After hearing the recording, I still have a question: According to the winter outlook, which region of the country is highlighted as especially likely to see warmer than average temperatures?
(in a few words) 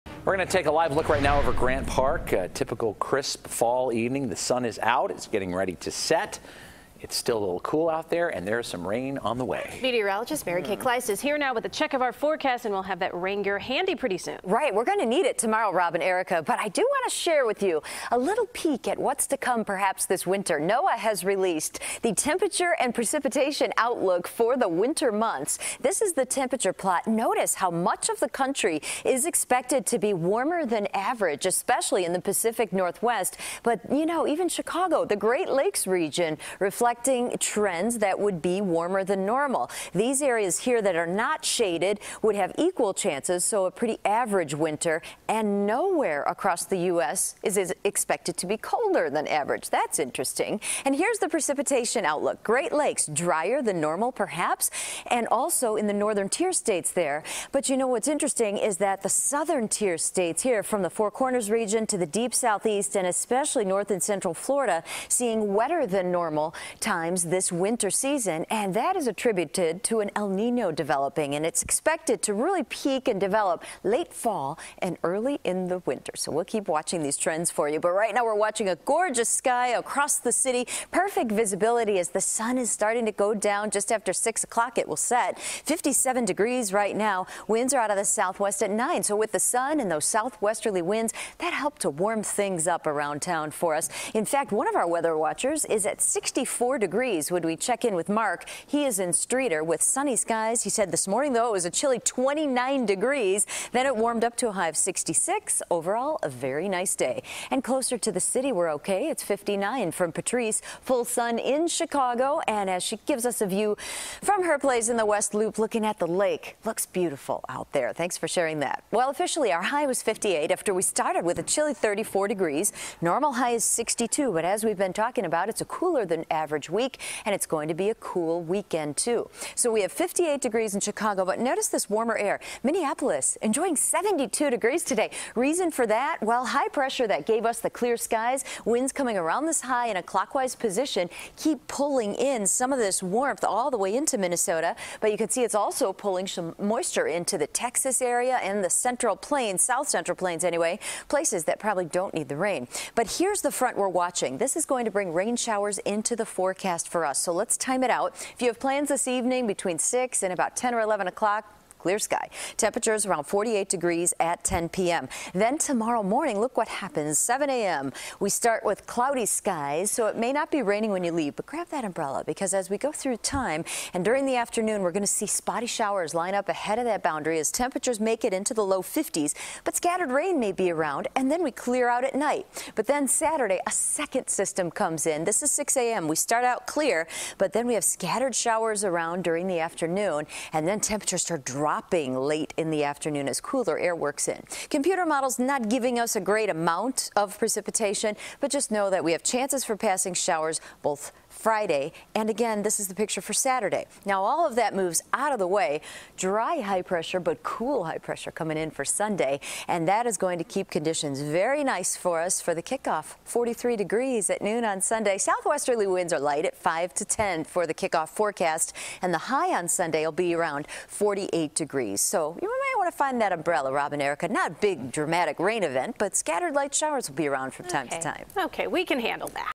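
Pacific Northwest.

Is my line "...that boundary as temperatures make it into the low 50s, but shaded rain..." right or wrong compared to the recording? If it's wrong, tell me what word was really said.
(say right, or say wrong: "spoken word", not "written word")
wrong: "scattered", not "shaded".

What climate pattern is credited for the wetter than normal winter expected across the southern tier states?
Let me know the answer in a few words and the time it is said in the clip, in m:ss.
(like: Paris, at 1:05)
El Nino, at 1:10.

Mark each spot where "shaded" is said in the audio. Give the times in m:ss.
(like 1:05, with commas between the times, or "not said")
0:41.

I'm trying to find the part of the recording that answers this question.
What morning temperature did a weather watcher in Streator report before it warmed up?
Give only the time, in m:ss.
1:41.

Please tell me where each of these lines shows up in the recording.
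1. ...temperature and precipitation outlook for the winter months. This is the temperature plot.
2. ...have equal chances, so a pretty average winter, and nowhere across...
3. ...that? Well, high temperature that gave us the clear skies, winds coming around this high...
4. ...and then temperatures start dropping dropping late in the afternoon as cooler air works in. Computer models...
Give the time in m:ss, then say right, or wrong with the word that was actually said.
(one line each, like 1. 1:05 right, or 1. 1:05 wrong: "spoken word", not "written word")
1. 0:22 right
2. 0:42 right
3. 2:15 wrong: "pressure", not "temperature"
4. 3:10 right.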